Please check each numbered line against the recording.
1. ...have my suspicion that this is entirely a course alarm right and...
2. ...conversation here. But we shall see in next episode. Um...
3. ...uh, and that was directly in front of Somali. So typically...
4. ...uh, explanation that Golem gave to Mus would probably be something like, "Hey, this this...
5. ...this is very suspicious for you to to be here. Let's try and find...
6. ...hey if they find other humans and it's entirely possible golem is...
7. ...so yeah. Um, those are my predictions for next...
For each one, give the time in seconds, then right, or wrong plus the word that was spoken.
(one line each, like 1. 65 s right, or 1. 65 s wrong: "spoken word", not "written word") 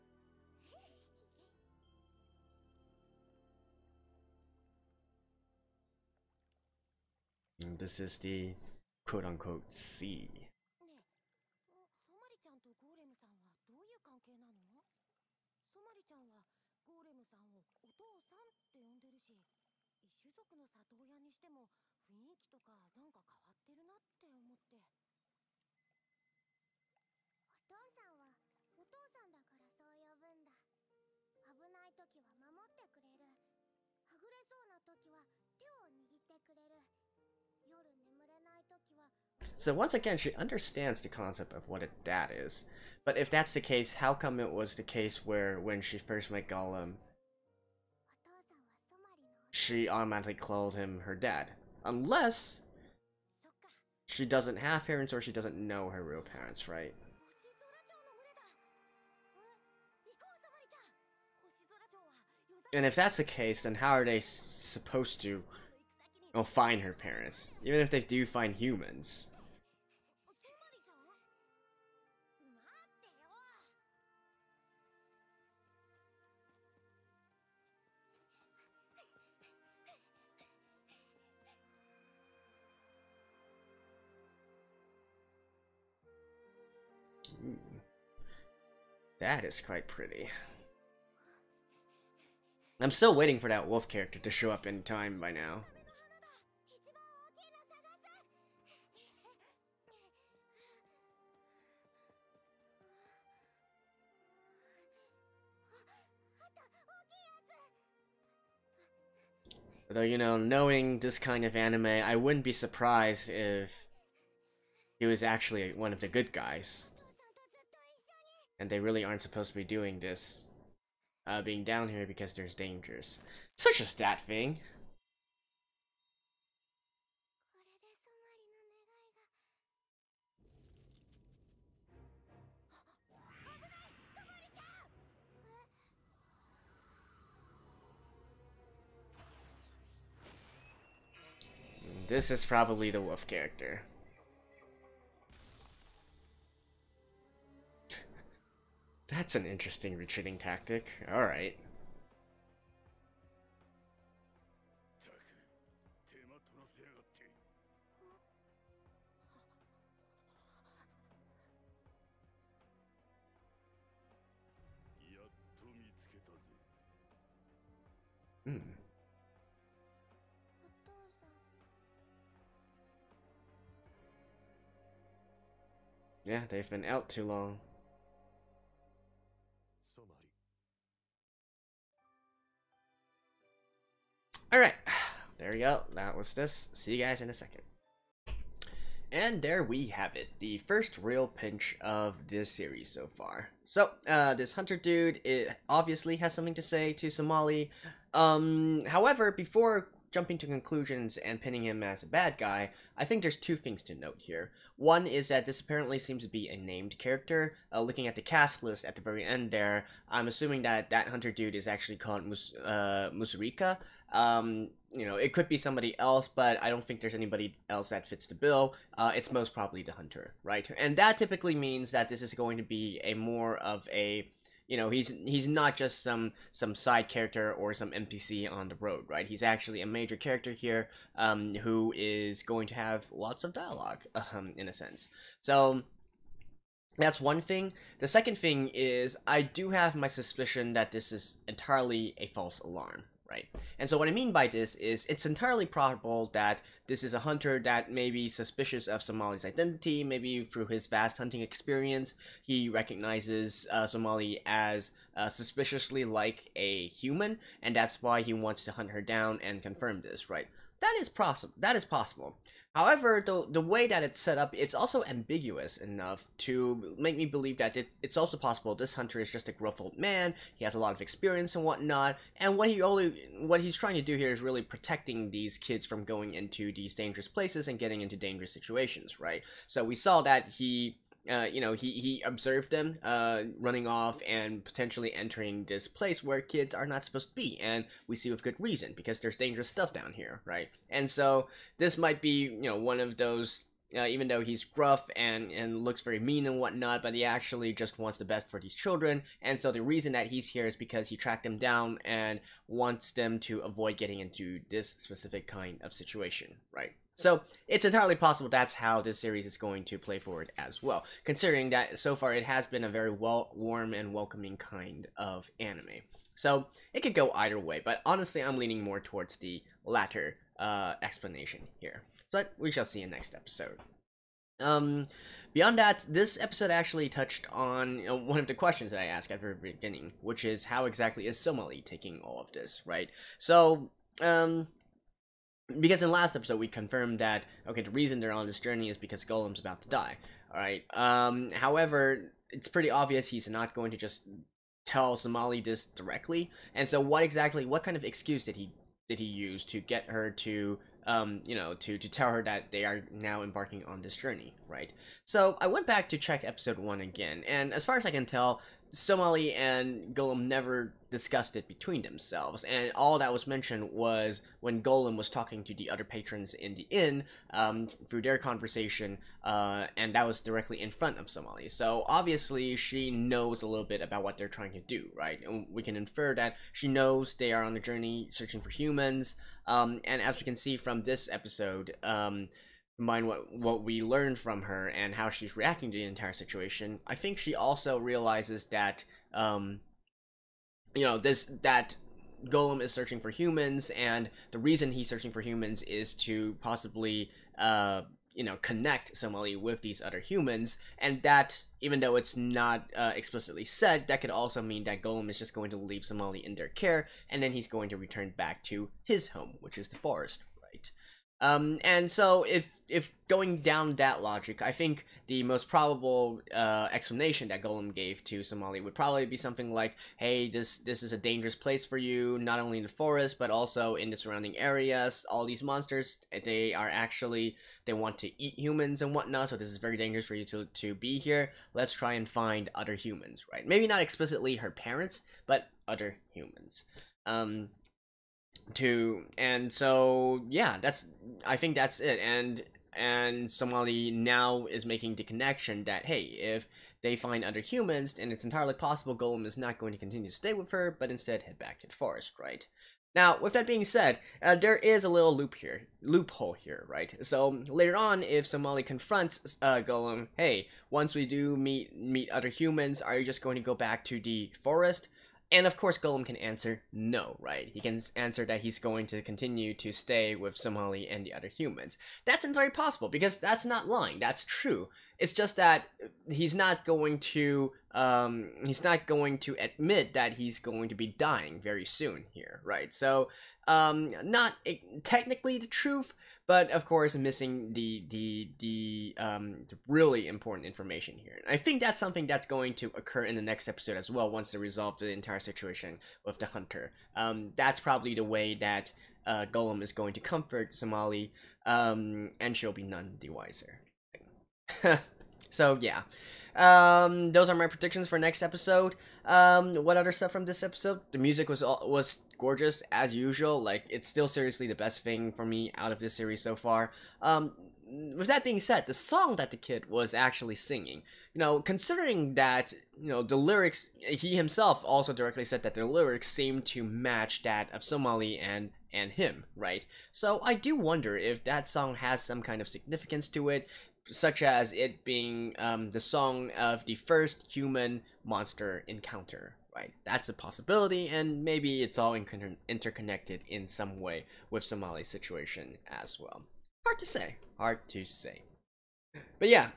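1. 239 s wrong: "false", not "course"
2. 321 s wrong: "explanation", not "conversation"
3. 369 s wrong: "obviously", not "typically"
4. 416 s wrong: "Somali", not "Mus"
5. 429 s wrong: "dangerous", not "suspicious"
6. 446 s right
7. 505 s right.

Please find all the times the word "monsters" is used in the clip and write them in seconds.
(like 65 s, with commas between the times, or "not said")
425 s, 538 s.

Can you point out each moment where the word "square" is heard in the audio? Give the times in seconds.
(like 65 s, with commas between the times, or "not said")
not said.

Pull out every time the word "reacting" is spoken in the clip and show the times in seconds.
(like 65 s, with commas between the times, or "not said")
385 s.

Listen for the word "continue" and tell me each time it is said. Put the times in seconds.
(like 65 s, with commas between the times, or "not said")
449 s, 469 s.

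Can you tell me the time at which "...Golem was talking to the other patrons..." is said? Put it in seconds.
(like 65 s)
364 s.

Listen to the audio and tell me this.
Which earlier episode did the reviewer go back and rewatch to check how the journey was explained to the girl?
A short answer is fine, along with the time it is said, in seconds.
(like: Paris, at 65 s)
episode one, at 356 s.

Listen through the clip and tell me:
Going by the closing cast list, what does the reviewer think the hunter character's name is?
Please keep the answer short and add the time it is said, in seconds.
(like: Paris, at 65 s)
Musurika, at 213 s.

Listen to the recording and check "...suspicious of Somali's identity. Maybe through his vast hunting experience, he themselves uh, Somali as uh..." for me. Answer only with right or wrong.
wrong.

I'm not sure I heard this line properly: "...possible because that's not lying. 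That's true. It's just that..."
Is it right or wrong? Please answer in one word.
right.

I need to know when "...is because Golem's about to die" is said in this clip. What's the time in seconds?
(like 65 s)
338 s.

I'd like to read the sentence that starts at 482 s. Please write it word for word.
So um, not technically the truth, but of course missing the the the um, really important information here.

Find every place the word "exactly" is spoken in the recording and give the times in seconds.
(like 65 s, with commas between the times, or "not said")
330 s, 347 s.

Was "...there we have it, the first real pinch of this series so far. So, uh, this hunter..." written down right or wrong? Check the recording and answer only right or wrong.
right.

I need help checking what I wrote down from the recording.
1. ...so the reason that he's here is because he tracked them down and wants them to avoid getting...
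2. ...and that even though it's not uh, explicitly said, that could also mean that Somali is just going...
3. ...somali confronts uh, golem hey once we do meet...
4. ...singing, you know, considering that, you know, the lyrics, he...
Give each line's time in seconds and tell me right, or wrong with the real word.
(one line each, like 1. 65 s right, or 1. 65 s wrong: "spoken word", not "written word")
1. 299 s right
2. 400 s wrong: "Golem", not "Somali"
3. 458 s right
4. 520 s right.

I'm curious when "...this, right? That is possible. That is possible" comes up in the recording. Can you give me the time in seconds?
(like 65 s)
260 s.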